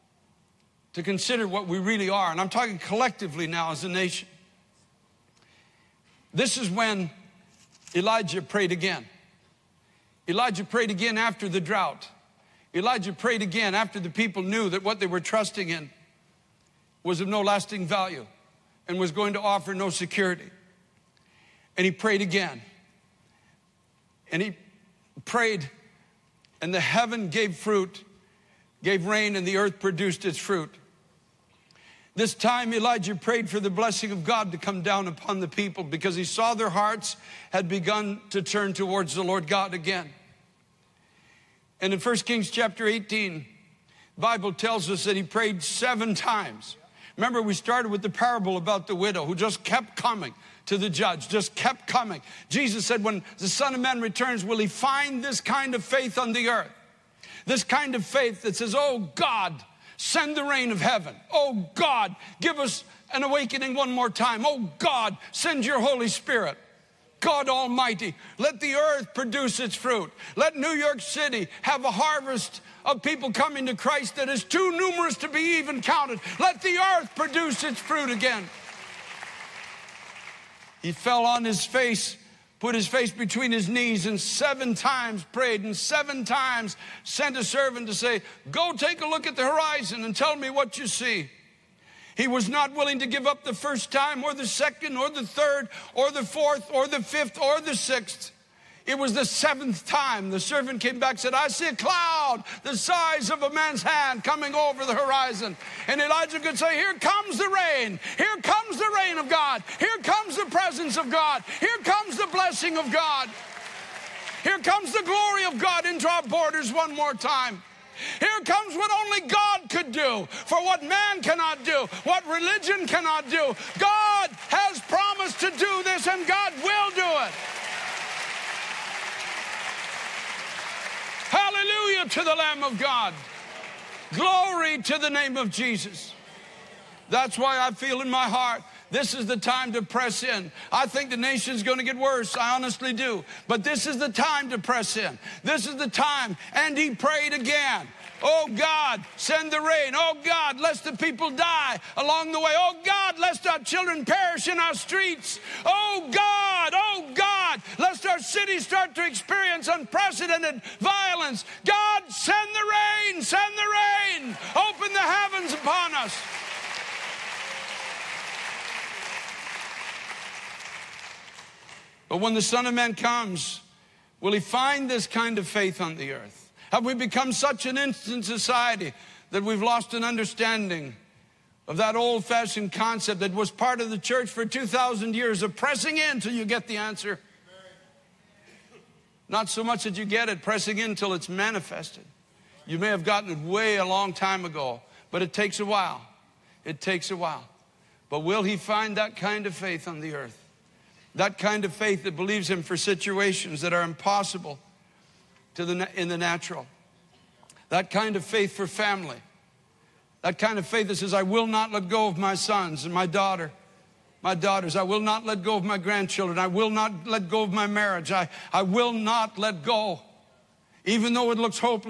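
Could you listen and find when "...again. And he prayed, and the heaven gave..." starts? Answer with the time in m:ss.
0:22.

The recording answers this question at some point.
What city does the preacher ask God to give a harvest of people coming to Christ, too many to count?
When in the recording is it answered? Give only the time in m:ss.
1:10.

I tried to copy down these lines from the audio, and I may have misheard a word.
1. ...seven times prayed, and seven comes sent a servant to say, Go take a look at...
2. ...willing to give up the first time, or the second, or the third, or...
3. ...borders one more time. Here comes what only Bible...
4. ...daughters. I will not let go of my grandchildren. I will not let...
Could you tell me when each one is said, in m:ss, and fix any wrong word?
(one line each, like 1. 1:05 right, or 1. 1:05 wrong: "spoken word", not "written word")
1. 1:24 wrong: "times", not "comes"
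2. 1:32 right
3. 1:56 wrong: "God", not "Bible"
4. 3:34 right.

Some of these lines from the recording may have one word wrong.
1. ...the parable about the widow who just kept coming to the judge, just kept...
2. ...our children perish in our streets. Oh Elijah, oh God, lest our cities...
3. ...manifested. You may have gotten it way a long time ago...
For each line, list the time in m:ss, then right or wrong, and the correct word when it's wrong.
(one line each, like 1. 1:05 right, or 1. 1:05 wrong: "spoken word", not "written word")
1. 0:48 right
2. 2:33 wrong: "God", not "Elijah"
3. 3:11 right.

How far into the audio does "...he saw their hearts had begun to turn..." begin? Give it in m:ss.
0:36.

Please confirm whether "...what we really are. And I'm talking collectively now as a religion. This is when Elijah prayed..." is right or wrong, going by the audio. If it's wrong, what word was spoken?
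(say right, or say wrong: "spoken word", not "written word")
wrong: "nation", not "religion".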